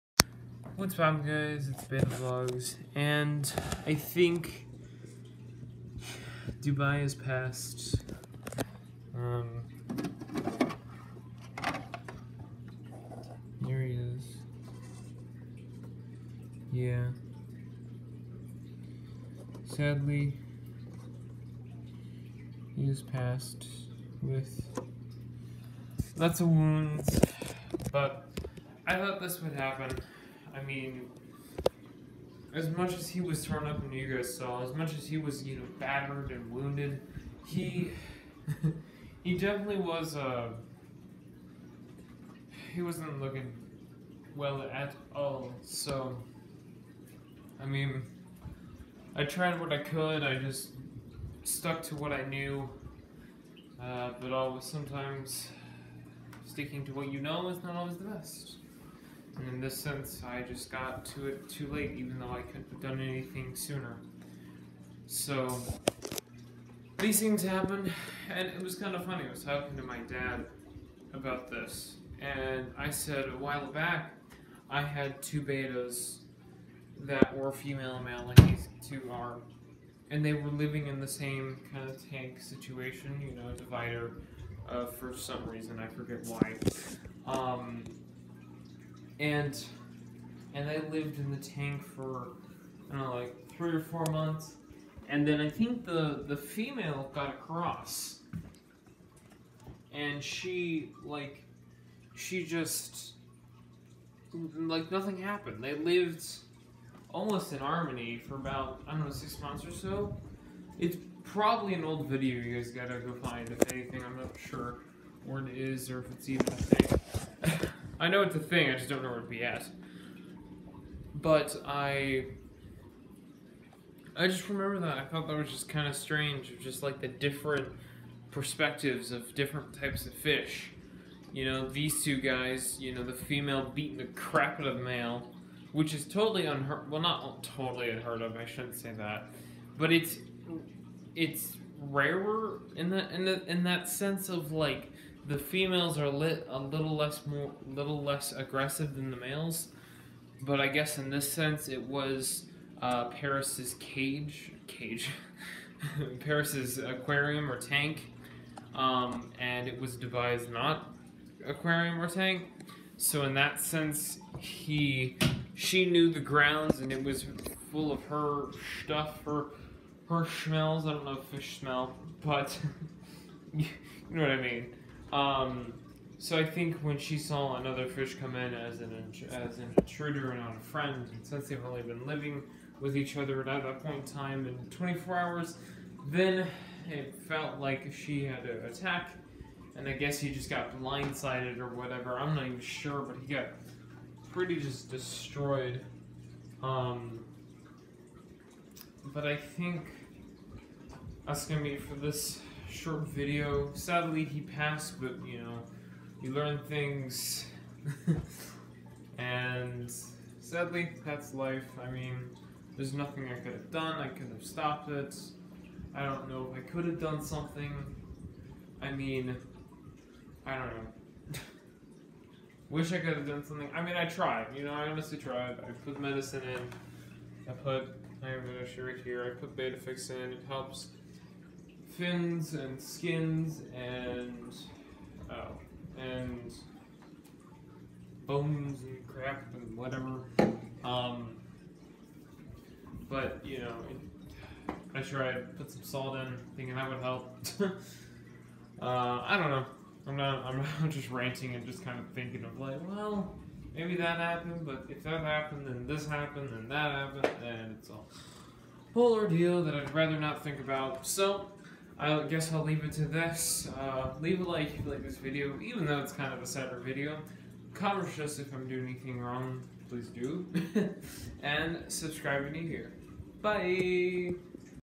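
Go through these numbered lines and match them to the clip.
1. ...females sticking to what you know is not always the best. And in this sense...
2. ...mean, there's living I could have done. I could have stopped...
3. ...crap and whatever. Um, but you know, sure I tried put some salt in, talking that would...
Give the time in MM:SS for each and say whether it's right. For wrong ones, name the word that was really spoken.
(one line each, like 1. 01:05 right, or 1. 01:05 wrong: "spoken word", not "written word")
1. 00:54 wrong: "sometimes", not "females"
2. 03:31 wrong: "nothing", not "living"
3. 03:59 wrong: "thinking", not "talking".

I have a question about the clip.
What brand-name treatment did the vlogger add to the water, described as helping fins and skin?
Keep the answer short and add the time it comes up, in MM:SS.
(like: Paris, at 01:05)
Bettafix, at 03:49.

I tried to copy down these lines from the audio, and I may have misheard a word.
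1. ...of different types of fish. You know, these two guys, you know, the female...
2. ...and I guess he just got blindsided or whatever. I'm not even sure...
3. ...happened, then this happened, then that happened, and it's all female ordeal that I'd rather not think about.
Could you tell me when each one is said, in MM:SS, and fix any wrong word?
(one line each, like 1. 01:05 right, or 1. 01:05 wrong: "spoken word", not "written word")
1. 02:09 right
2. 03:09 right
3. 04:15 wrong: "whole", not "female".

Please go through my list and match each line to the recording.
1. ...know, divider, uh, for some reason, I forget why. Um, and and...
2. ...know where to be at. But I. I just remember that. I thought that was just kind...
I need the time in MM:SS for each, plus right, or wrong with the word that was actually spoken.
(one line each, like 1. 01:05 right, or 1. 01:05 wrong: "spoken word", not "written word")
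1. 01:23 right
2. 01:59 right.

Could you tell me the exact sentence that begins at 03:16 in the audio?
Um, but I think that's gonna be for this short video.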